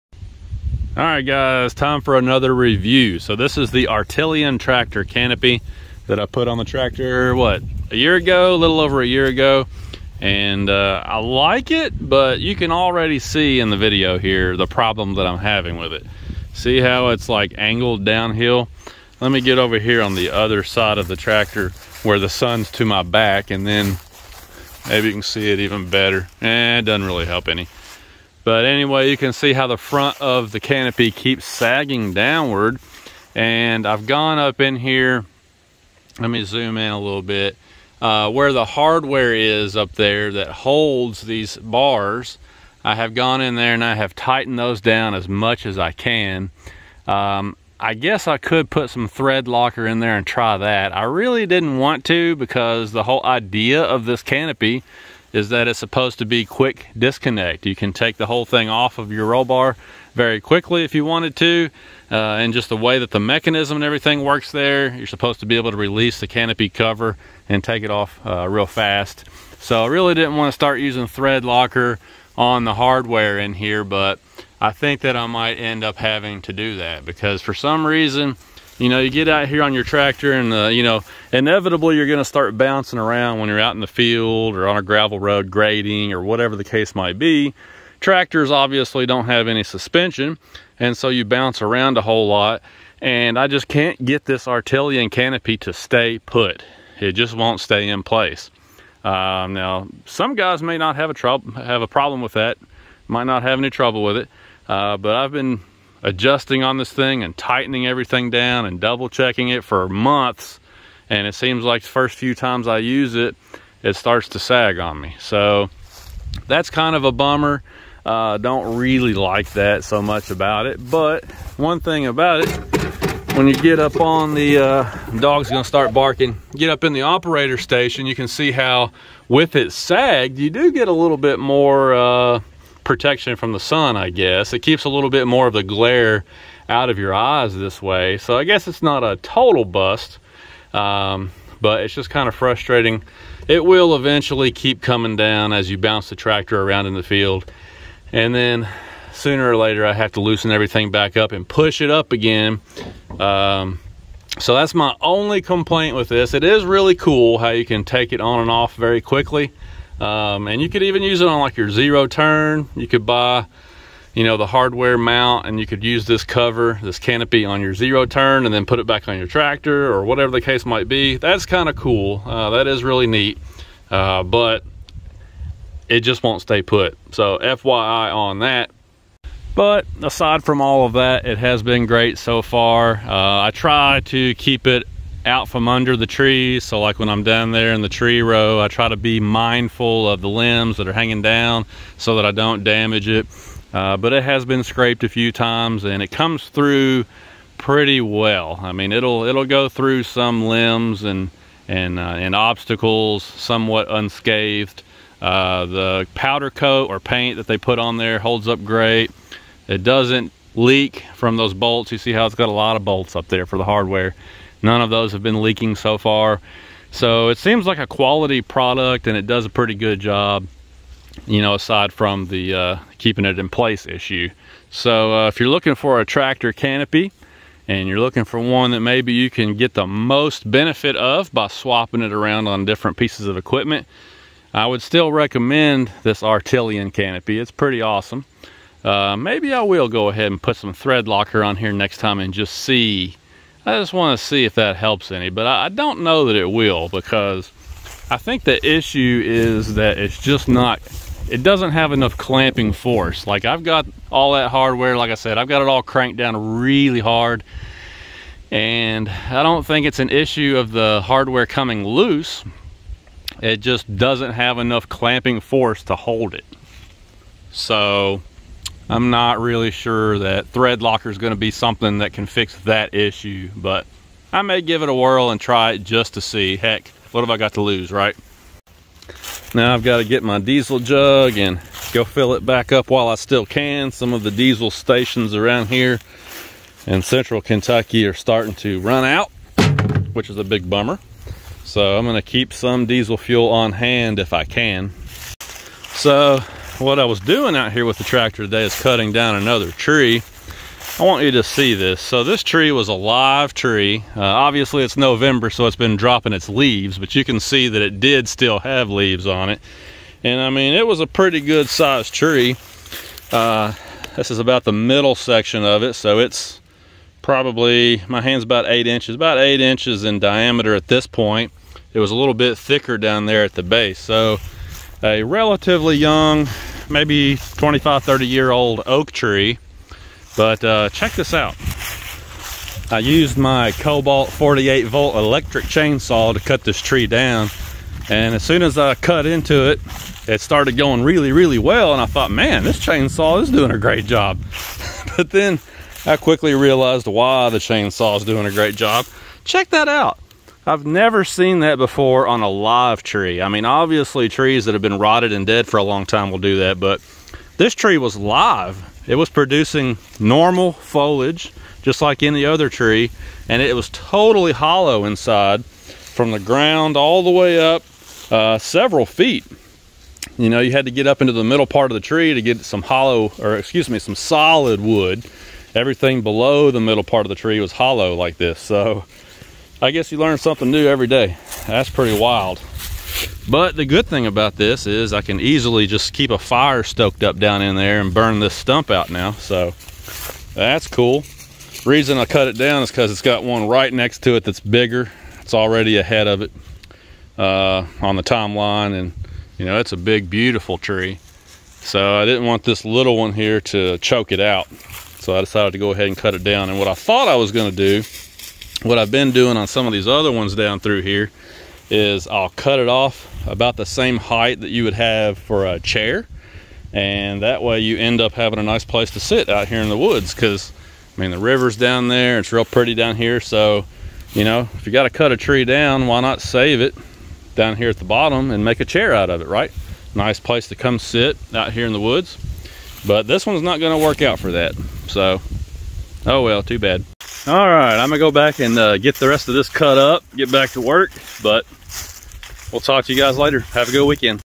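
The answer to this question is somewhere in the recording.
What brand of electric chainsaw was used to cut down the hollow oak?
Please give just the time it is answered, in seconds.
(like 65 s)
333 s.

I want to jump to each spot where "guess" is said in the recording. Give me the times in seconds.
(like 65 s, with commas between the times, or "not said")
47 s, 134 s, 138 s, 379 s.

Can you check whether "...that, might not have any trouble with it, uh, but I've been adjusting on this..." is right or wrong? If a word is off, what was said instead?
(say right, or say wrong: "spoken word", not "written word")
right.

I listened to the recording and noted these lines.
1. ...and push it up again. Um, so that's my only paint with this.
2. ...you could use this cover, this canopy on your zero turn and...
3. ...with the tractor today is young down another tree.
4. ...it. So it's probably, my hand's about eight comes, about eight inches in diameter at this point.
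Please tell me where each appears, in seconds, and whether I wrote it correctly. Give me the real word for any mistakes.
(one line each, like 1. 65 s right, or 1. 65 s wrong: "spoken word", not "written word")
1. 151 s wrong: "complaint", not "paint"
2. 165 s right
3. 297 s wrong: "cutting", not "young"
4. 315 s wrong: "inches", not "comes".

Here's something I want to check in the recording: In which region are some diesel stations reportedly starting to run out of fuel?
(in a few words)
central Kentucky.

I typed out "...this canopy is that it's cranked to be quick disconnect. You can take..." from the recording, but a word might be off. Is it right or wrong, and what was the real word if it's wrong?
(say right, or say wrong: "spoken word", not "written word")
wrong: "supposed", not "cranked".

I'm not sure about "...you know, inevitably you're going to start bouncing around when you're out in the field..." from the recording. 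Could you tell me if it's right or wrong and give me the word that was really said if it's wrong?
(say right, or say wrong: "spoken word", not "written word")
right.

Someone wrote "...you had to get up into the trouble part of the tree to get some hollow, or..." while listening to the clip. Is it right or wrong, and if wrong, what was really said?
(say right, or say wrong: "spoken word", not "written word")
wrong: "middle", not "trouble".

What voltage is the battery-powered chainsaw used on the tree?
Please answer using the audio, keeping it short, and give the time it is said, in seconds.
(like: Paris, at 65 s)
48 volt, at 334 s.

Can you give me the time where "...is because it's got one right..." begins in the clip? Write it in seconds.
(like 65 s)
392 s.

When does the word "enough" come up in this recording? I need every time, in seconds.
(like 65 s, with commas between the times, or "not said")
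251 s, 264 s.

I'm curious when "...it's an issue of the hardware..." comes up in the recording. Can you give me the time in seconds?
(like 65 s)
259 s.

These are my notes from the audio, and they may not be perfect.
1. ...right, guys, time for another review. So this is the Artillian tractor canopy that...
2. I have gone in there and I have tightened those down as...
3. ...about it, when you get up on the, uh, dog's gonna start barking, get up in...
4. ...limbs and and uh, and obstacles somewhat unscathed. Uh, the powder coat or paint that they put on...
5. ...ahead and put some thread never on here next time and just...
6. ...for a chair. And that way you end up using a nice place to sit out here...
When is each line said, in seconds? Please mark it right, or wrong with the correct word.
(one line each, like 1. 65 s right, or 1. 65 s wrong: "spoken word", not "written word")
1. 1 s right
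2. 42 s right
3. 122 s right
4. 200 s right
5. 240 s wrong: "locker", not "never"
6. 415 s wrong: "having", not "using".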